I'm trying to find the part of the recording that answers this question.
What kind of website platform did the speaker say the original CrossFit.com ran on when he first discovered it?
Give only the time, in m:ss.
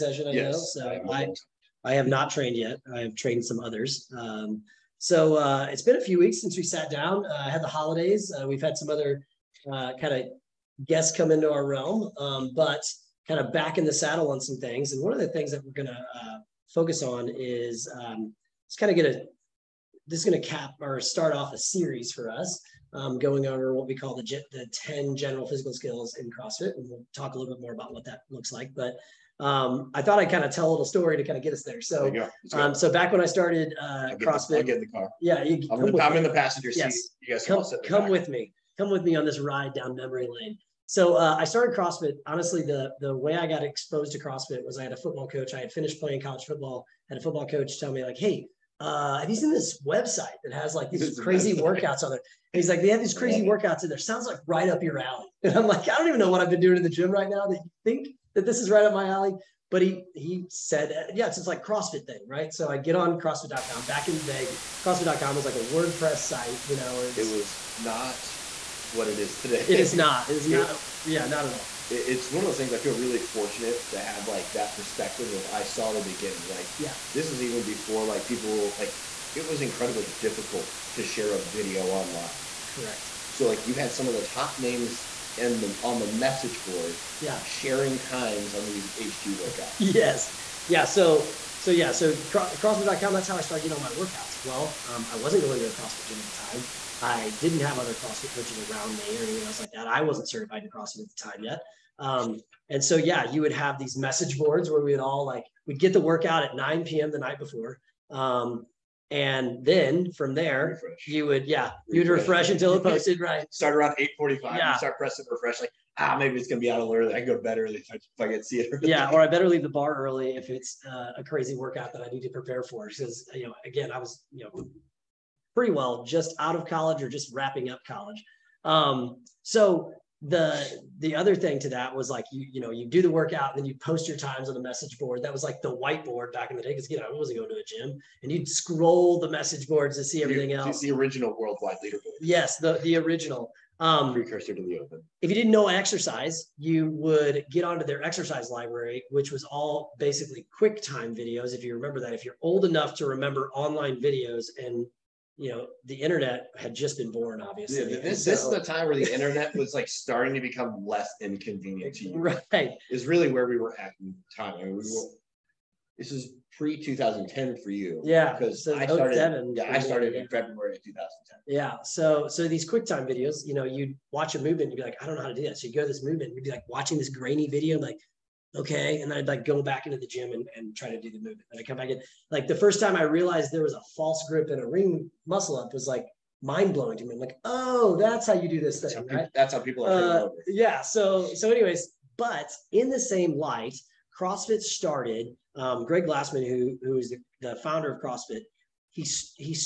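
1:05.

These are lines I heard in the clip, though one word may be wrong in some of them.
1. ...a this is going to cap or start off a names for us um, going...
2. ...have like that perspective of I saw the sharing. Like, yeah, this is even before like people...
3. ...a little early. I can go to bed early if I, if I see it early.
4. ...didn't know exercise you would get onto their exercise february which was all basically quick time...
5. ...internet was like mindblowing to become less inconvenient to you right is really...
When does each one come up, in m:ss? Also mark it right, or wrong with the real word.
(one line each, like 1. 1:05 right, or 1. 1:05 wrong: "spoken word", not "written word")
1. 0:19 wrong: "series", not "names"
2. 1:14 wrong: "beginning", not "sharing"
3. 1:56 right
4. 2:25 wrong: "library", not "february"
5. 2:39 wrong: "starting", not "mindblowing".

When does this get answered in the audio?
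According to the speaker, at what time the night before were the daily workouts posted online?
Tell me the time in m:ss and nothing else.
1:46.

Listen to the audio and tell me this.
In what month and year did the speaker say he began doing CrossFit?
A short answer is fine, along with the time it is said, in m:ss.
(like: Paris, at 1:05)
February 2010, at 2:50.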